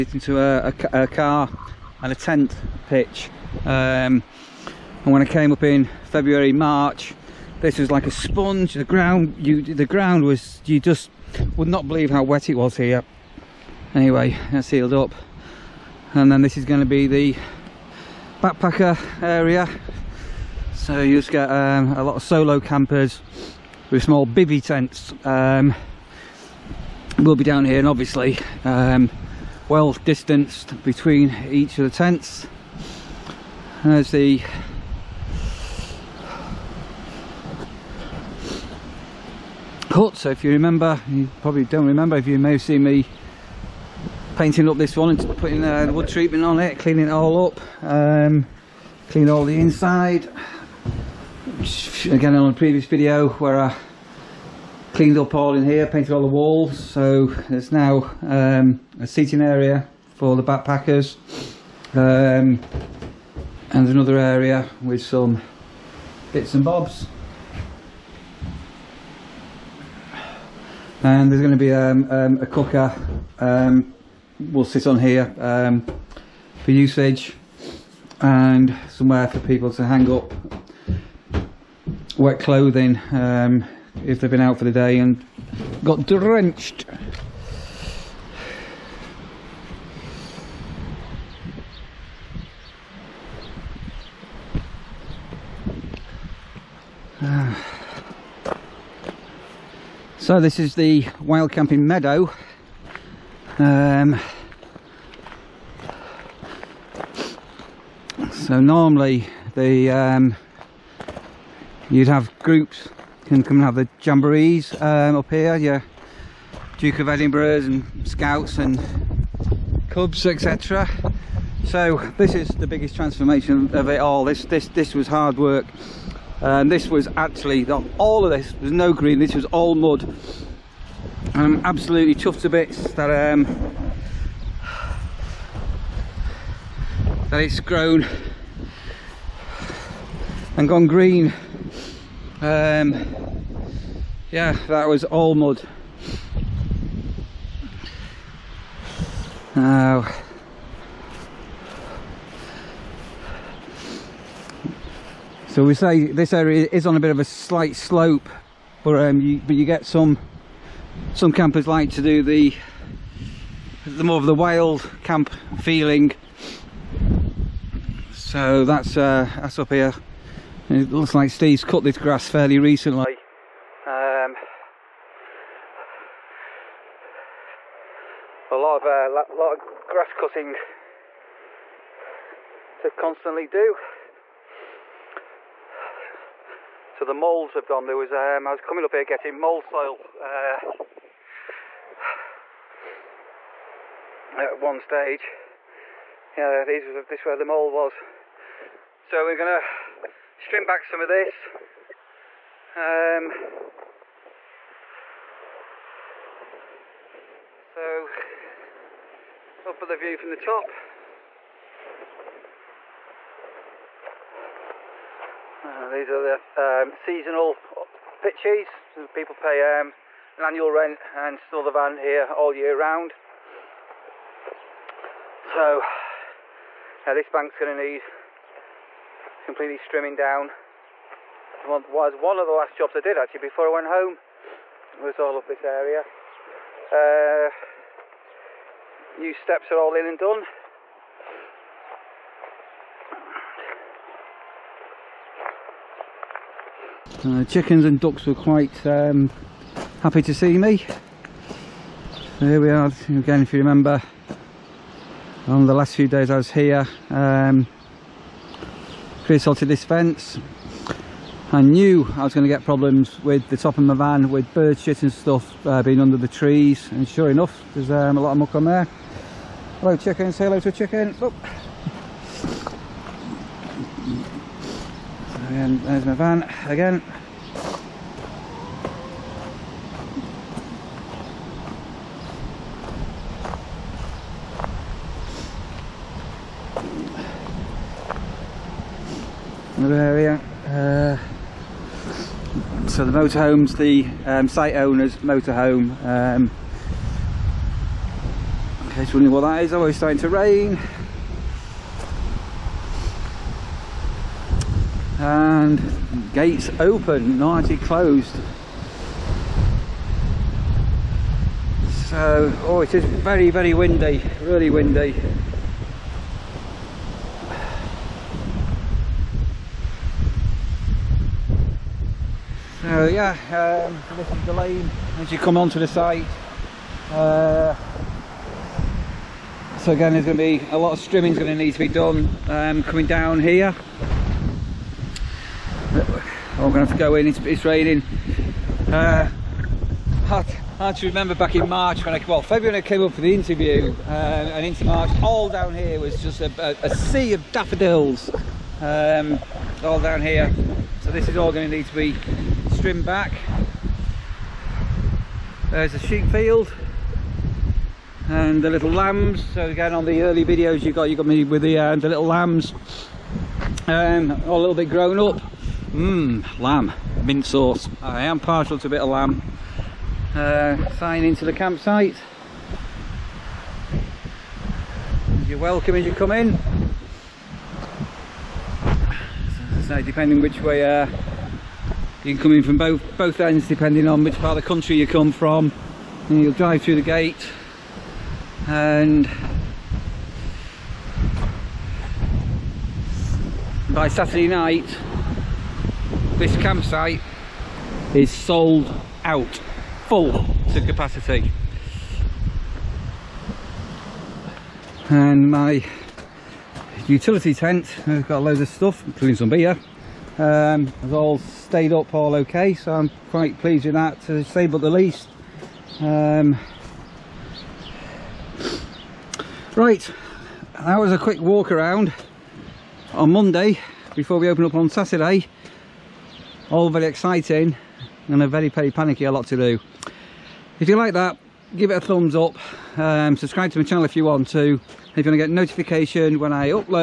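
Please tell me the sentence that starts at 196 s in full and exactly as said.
Yeah, these was this where the mould was.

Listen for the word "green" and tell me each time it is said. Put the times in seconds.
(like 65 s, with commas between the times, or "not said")
128 s, 140 s.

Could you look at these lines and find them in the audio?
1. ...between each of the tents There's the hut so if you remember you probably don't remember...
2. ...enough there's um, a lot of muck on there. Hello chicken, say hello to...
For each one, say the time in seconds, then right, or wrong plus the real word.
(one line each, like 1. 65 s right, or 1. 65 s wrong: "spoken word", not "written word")
1. 30 s right
2. 267 s right.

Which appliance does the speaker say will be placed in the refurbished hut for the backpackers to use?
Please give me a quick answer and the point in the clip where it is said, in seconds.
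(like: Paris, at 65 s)
a cooker, at 72 s.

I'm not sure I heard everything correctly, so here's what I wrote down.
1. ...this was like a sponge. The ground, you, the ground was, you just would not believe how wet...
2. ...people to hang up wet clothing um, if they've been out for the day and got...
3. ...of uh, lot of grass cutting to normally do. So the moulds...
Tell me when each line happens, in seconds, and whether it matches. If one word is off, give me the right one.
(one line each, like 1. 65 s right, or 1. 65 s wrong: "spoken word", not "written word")
1. 7 s right
2. 79 s right
3. 178 s wrong: "constantly", not "normally".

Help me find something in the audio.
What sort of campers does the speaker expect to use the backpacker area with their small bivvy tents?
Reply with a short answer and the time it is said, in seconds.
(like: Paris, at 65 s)
solo campers, at 22 s.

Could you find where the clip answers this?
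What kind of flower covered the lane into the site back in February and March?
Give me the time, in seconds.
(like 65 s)
347 s.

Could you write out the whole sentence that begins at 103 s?
Um, so normally the um, you'd have groups can come and have the jamborees um, up here.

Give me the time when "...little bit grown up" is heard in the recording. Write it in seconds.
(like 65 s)
364 s.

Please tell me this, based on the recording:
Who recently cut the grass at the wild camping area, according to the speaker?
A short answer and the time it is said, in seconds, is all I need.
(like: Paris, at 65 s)
Steve, at 171 s.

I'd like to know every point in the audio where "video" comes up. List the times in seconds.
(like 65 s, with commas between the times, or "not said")
52 s, 360 s.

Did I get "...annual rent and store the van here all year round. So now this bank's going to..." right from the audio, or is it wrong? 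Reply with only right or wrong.
right.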